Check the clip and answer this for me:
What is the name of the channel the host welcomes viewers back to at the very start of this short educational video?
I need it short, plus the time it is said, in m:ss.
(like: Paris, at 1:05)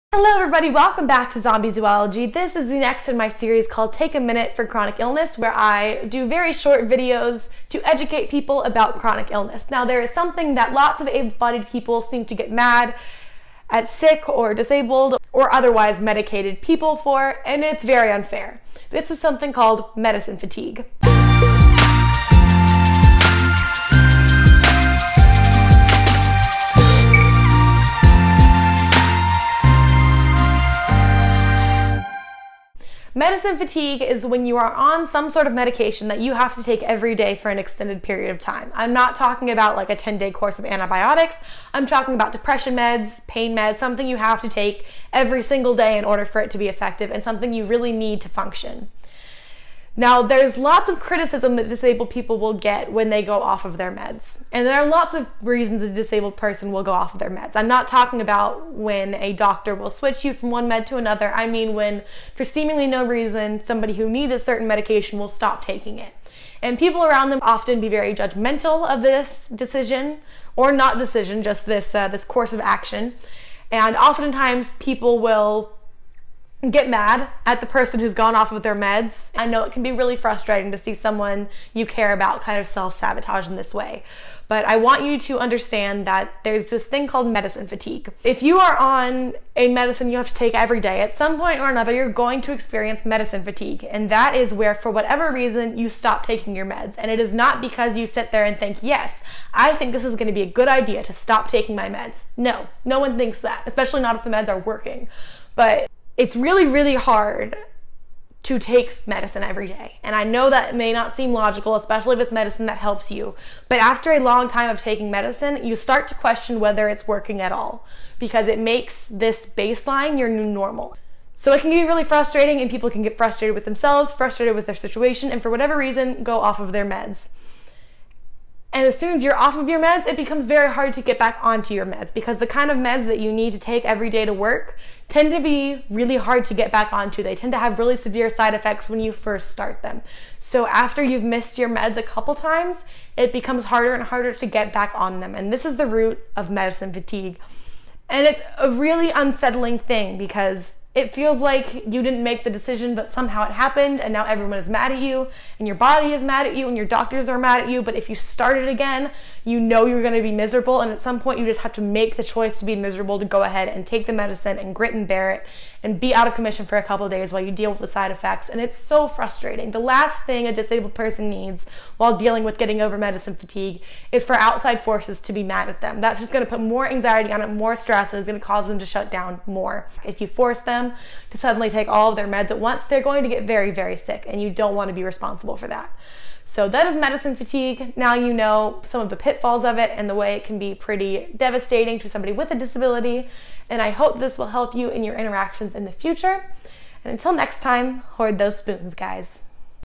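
Zombie Zoology, at 0:01.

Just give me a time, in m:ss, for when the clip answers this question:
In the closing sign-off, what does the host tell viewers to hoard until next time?
3:18.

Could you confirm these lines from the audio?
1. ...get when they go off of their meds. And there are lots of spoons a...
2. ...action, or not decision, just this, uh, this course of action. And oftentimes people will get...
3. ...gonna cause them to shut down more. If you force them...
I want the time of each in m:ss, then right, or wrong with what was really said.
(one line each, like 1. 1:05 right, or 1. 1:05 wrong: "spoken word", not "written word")
1. 0:52 wrong: "reasons", not "spoons"
2. 1:09 wrong: "decision", not "action"
3. 2:58 right.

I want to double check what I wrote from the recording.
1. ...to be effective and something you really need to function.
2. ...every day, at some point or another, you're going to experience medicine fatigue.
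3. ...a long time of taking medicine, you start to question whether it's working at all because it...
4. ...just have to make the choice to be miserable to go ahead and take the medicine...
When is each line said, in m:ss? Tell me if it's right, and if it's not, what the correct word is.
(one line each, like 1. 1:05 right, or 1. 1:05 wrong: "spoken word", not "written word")
1. 0:46 right
2. 1:30 right
3. 1:54 right
4. 2:41 right.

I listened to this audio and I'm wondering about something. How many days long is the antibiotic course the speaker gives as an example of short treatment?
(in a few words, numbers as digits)
10.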